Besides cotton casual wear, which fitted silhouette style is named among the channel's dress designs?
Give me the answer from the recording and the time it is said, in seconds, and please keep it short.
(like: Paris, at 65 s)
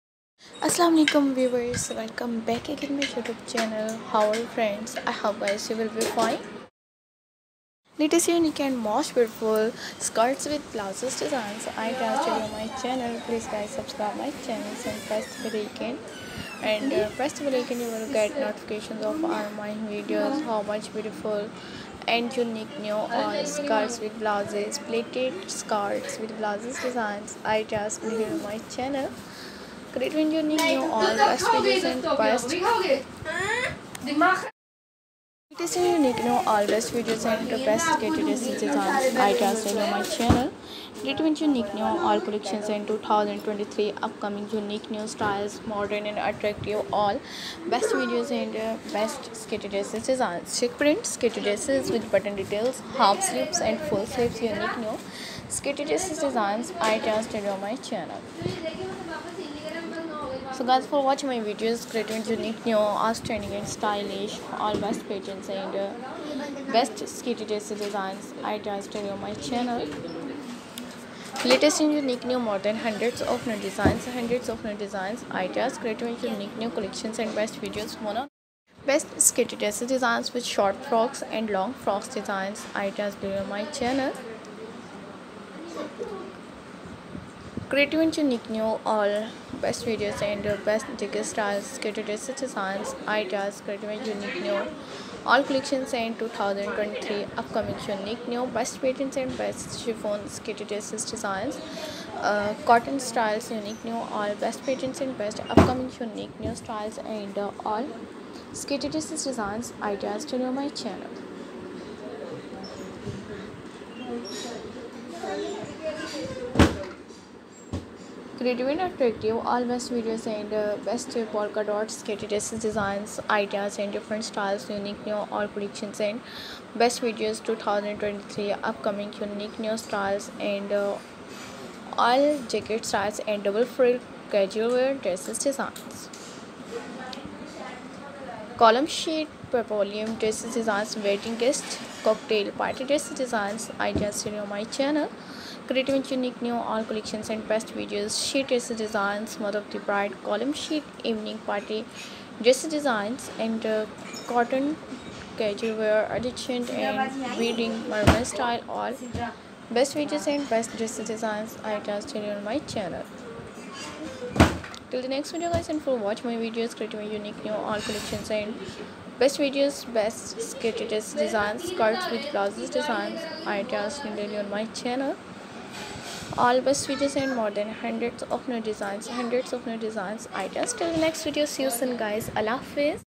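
Mermaid style, at 157 s.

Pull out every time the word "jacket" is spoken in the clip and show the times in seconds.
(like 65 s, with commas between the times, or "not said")
132 s.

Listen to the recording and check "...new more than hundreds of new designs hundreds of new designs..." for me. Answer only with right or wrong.
right.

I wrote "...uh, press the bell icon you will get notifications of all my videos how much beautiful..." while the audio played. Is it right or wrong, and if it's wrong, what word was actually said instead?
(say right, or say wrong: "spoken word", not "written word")
right.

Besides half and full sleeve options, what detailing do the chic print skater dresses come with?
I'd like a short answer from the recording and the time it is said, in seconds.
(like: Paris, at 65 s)
Button details, at 52 s.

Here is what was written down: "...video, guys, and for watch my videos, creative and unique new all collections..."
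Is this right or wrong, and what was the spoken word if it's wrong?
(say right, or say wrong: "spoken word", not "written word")
right.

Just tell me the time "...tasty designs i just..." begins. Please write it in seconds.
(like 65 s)
67 s.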